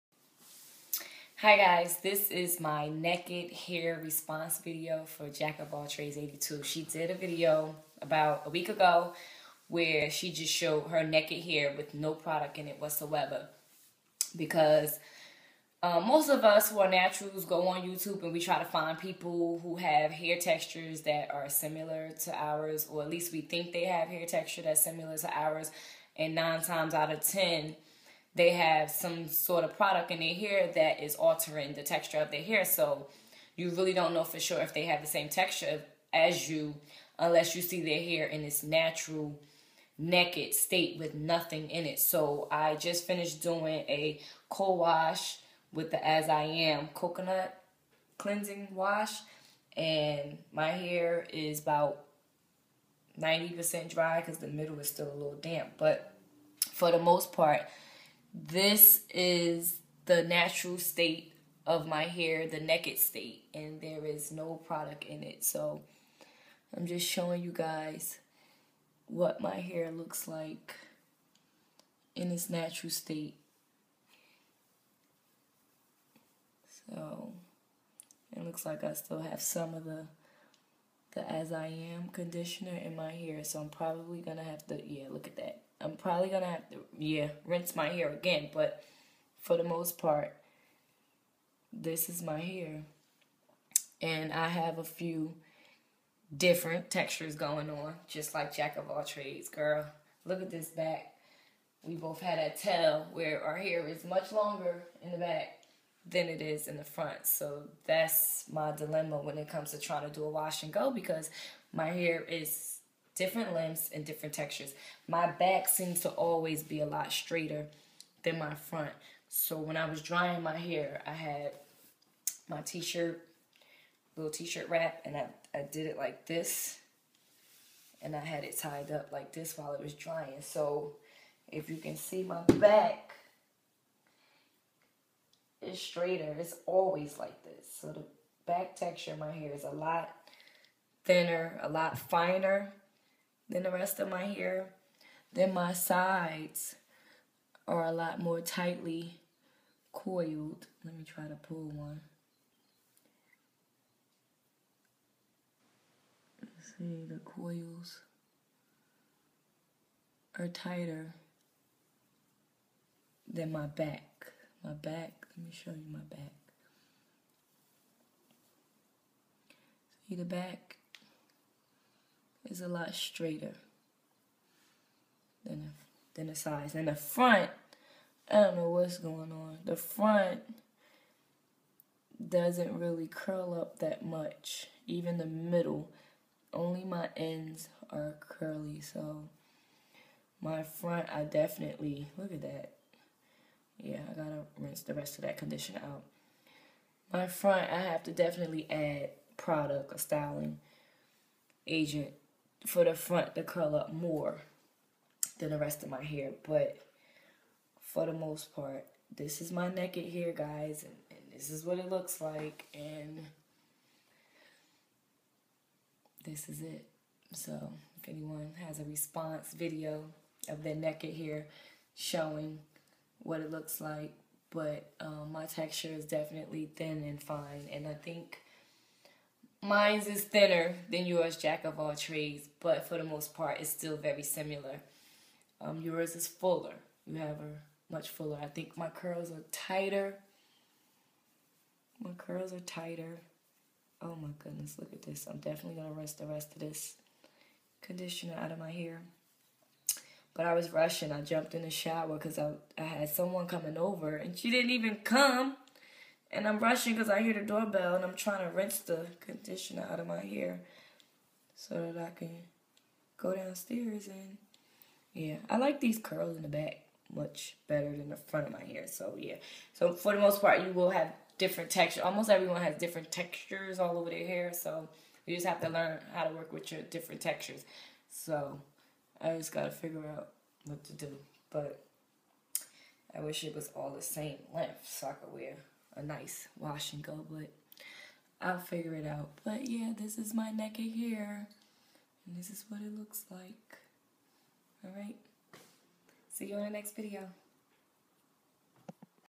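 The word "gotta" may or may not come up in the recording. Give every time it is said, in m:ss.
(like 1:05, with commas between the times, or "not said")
3:14, 4:39.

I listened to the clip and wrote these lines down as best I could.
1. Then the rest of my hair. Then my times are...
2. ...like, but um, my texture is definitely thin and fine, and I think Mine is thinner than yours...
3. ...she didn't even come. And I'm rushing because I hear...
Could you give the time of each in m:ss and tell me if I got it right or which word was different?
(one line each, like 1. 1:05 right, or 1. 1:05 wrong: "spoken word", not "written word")
1. 2:23 wrong: "sides", not "times"
2. 3:43 right
3. 4:14 right.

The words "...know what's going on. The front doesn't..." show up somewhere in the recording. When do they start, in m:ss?
2:58.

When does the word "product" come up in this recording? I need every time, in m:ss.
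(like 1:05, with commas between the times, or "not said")
0:12, 0:29, 1:04, 3:19.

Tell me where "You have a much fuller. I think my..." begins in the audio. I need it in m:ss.
3:57.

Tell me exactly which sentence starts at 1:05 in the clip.
So I'm just showing you guys what my hair looks like in its natural state.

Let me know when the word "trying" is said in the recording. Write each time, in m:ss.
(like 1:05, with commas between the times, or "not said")
1:49, 4:18.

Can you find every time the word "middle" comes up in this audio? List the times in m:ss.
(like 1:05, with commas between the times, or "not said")
0:54, 3:05.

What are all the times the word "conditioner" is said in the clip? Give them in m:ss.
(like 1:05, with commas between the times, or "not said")
1:22, 3:15, 4:07, 4:19.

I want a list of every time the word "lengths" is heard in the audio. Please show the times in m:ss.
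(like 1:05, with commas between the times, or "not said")
1:53, 4:44.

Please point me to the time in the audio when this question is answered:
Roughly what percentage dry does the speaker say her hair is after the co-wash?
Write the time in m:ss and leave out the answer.
0:53.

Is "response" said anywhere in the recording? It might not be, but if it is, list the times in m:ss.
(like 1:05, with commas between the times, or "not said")
0:04, 3:38.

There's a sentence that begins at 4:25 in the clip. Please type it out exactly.
I like these curls in the back much better than the front of my hair.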